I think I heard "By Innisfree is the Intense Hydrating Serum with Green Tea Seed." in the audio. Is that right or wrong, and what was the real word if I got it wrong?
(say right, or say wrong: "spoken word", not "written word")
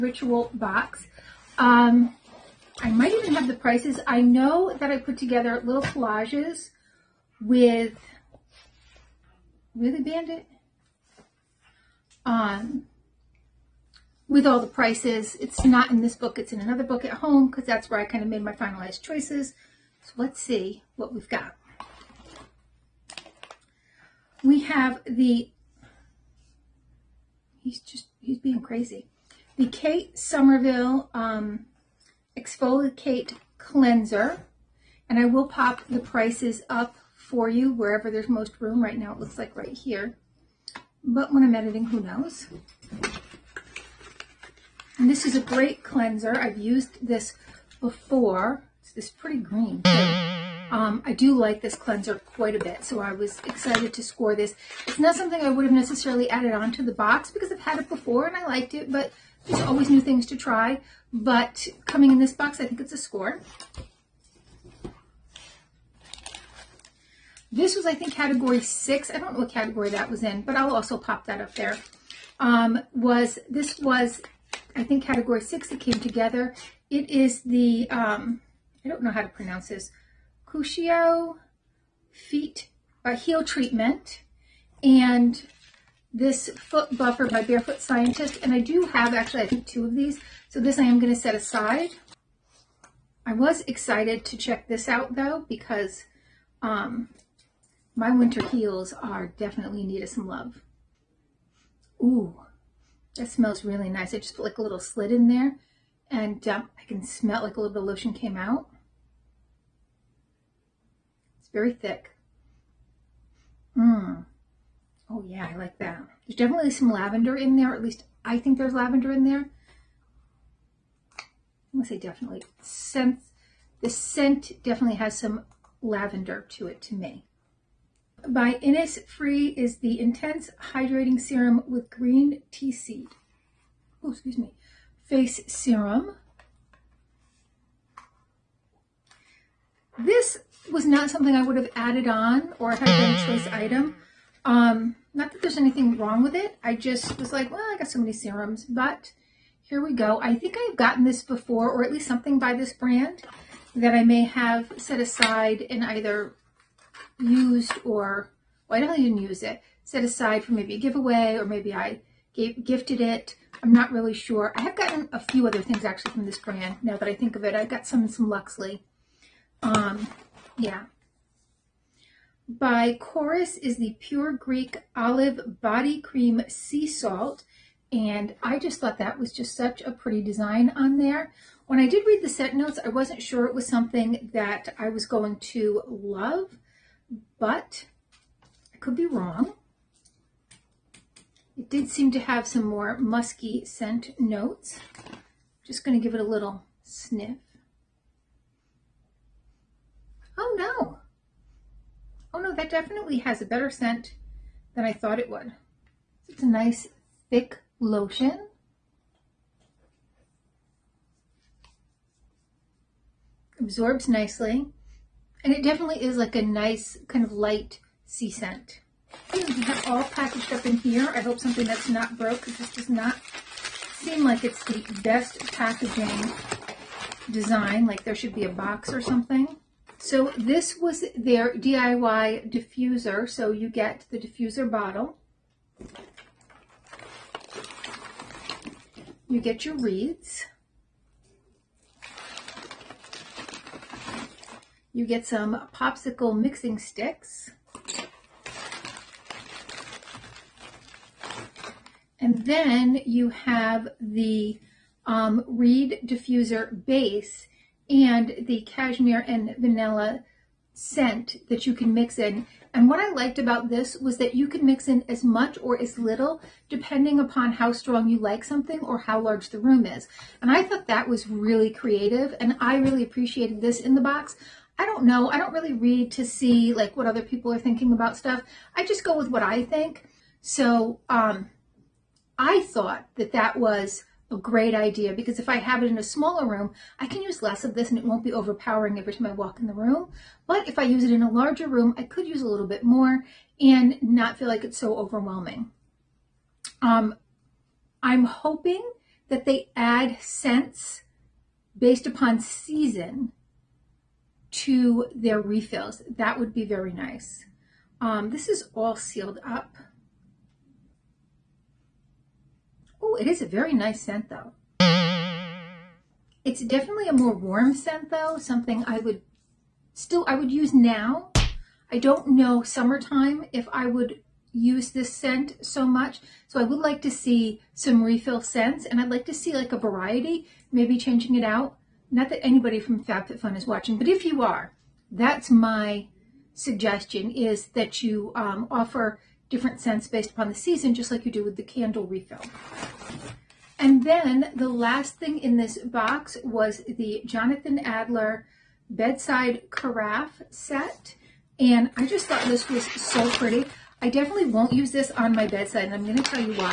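right.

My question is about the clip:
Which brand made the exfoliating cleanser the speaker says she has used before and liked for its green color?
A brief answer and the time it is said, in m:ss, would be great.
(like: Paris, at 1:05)
Kate Somerville, at 0:29.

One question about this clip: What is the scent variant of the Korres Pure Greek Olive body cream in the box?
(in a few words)
Sea Salt.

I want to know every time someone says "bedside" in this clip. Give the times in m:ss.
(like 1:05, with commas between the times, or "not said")
5:48, 5:55.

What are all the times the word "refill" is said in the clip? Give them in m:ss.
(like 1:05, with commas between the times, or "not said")
5:05, 5:28, 5:42.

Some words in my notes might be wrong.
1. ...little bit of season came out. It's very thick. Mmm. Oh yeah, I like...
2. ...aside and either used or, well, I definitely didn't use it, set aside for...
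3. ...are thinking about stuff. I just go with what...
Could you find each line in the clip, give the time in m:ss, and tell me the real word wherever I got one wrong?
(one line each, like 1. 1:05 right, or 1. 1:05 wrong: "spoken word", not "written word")
1. 1:47 wrong: "lotion", not "season"
2. 2:34 right
3. 4:37 right.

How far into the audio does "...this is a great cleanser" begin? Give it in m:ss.
0:45.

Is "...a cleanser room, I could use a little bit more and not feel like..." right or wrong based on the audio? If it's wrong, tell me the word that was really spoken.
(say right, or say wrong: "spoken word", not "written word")
wrong: "larger", not "cleanser".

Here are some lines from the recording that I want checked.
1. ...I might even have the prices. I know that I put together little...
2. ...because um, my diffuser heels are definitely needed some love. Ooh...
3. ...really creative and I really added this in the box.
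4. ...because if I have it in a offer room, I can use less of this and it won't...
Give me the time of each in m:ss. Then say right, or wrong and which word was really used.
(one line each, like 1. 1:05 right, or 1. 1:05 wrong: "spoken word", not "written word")
1. 0:02 right
2. 1:35 wrong: "winter", not "diffuser"
3. 4:31 wrong: "appreciated", not "added"
4. 4:45 wrong: "smaller", not "offer".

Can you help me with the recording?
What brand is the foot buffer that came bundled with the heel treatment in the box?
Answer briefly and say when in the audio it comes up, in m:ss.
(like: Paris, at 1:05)
Barefoot Scientist, at 1:27.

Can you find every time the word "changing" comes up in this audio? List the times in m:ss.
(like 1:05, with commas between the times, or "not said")
5:30.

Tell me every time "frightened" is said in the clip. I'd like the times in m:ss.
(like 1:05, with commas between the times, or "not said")
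not said.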